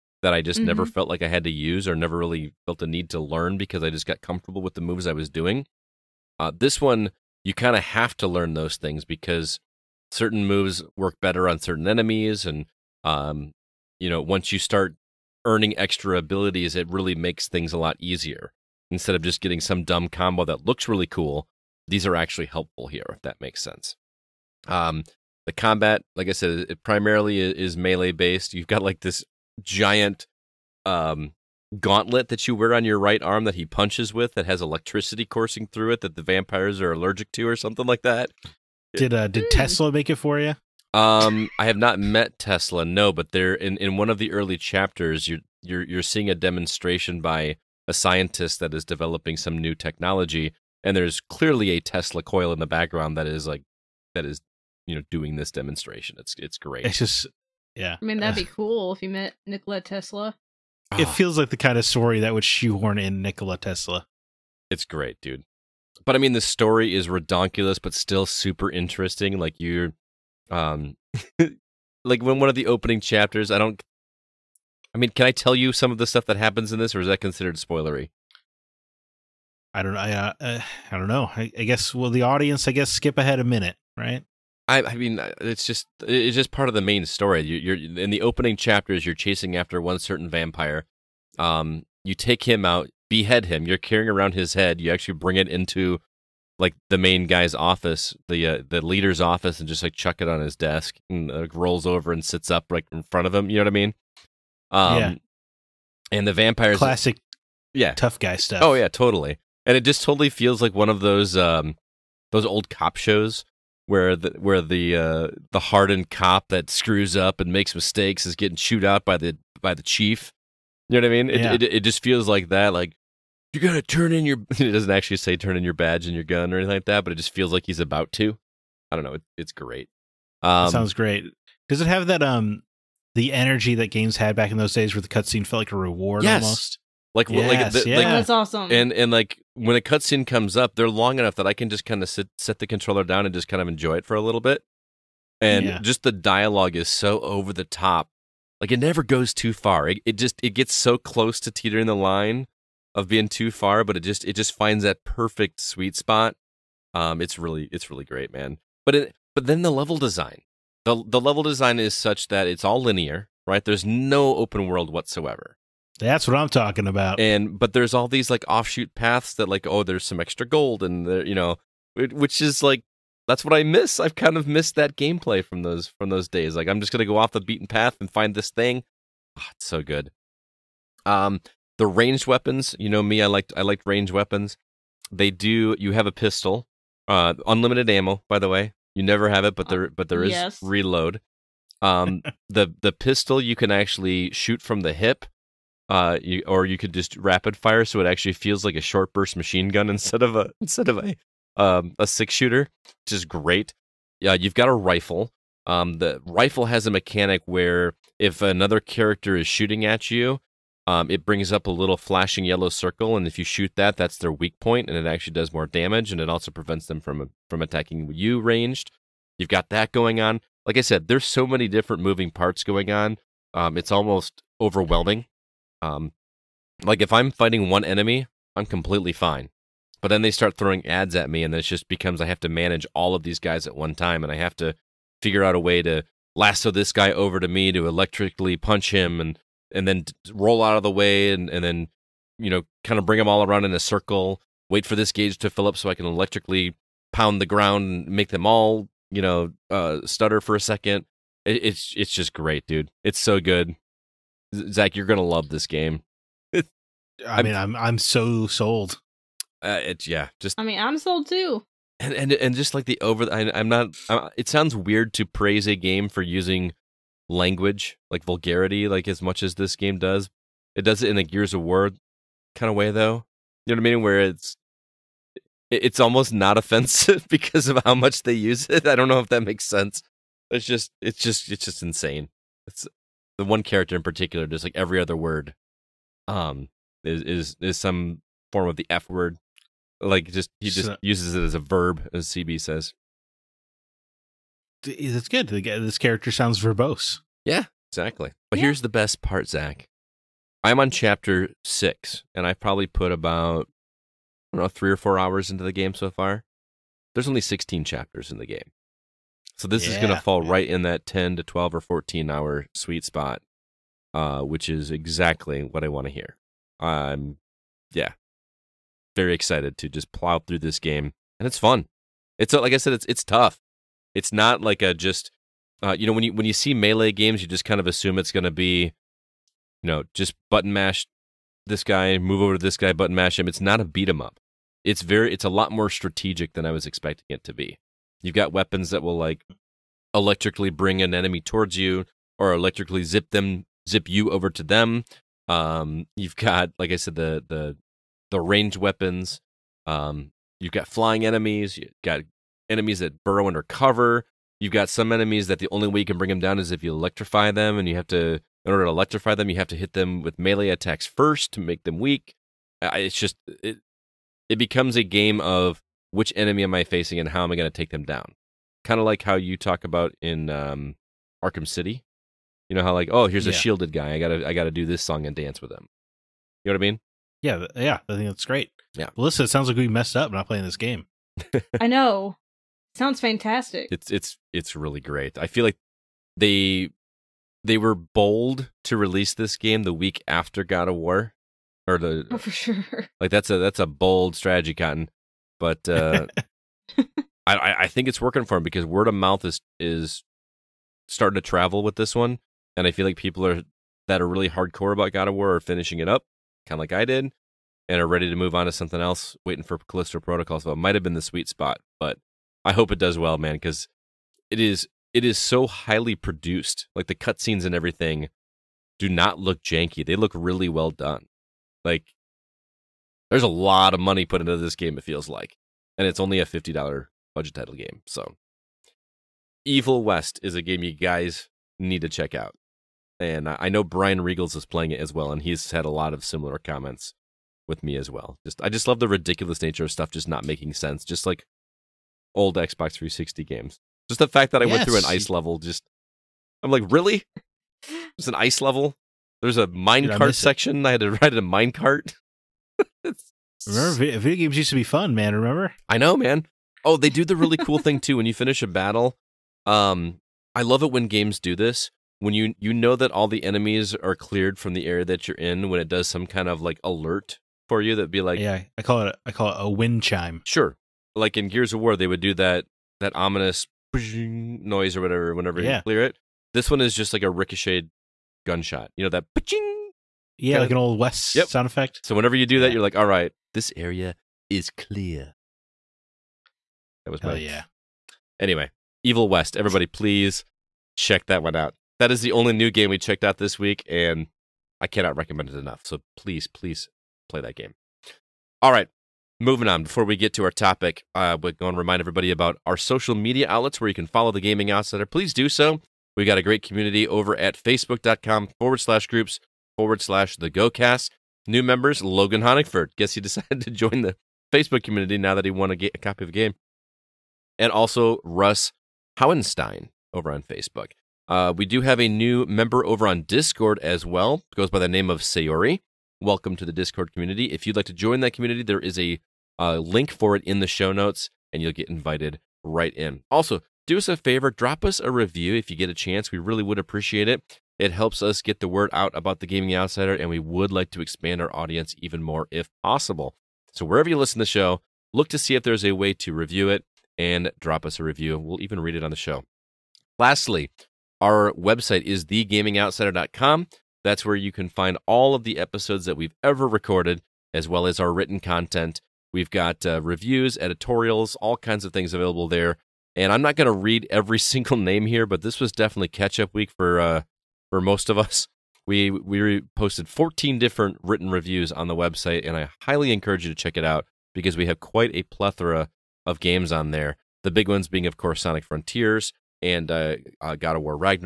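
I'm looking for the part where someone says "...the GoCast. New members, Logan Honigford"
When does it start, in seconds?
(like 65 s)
510 s.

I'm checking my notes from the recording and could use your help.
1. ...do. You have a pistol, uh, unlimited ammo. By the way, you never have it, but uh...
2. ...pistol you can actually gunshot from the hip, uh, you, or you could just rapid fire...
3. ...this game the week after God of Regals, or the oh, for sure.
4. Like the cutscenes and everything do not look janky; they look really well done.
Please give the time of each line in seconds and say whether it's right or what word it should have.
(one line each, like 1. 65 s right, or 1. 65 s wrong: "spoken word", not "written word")
1. 185 s right
2. 192 s wrong: "shoot", not "gunshot"
3. 389 s wrong: "War", not "Regals"
4. 416 s right.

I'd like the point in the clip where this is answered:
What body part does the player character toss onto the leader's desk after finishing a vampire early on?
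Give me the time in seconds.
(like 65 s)
94 s.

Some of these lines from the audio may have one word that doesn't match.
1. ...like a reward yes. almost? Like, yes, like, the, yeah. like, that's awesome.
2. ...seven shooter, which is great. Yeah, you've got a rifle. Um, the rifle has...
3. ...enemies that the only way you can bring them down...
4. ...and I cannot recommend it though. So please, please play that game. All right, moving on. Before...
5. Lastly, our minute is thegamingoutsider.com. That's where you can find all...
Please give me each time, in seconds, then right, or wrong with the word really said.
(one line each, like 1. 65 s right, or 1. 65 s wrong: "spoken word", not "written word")
1. 135 s right
2. 202 s wrong: "six", not "seven"
3. 355 s right
4. 493 s wrong: "enough", not "though"
5. 550 s wrong: "website", not "minute".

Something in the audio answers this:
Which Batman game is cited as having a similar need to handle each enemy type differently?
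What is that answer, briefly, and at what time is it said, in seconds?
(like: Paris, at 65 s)
Arkham City, at 371 s.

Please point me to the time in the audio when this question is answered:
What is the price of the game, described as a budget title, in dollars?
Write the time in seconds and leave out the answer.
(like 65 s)
426 s.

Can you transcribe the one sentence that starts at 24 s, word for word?
Um, the combat, like I said, it primarily is melee based.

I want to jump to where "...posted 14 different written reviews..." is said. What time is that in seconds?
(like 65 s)
569 s.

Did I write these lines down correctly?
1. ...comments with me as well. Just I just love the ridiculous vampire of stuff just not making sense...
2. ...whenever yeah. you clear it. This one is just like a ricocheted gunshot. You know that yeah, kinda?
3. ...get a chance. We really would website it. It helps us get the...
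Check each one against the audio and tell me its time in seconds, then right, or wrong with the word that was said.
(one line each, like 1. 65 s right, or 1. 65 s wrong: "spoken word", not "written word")
1. 436 s wrong: "nature", not "vampire"
2. 475 s right
3. 535 s wrong: "appreciate", not "website".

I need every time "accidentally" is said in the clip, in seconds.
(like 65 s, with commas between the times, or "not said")
not said.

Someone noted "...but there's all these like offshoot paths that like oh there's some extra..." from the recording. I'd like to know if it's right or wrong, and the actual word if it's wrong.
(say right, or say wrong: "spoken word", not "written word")
right.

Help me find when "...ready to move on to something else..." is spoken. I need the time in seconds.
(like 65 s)
408 s.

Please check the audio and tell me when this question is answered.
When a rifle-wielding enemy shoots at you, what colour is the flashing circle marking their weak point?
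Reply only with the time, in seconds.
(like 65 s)
212 s.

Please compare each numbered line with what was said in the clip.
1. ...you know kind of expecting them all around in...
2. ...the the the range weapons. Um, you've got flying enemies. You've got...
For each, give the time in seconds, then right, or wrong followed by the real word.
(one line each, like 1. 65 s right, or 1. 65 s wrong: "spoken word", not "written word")
1. 242 s wrong: "bring", not "expecting"
2. 347 s right.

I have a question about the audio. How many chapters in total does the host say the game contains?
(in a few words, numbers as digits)
16.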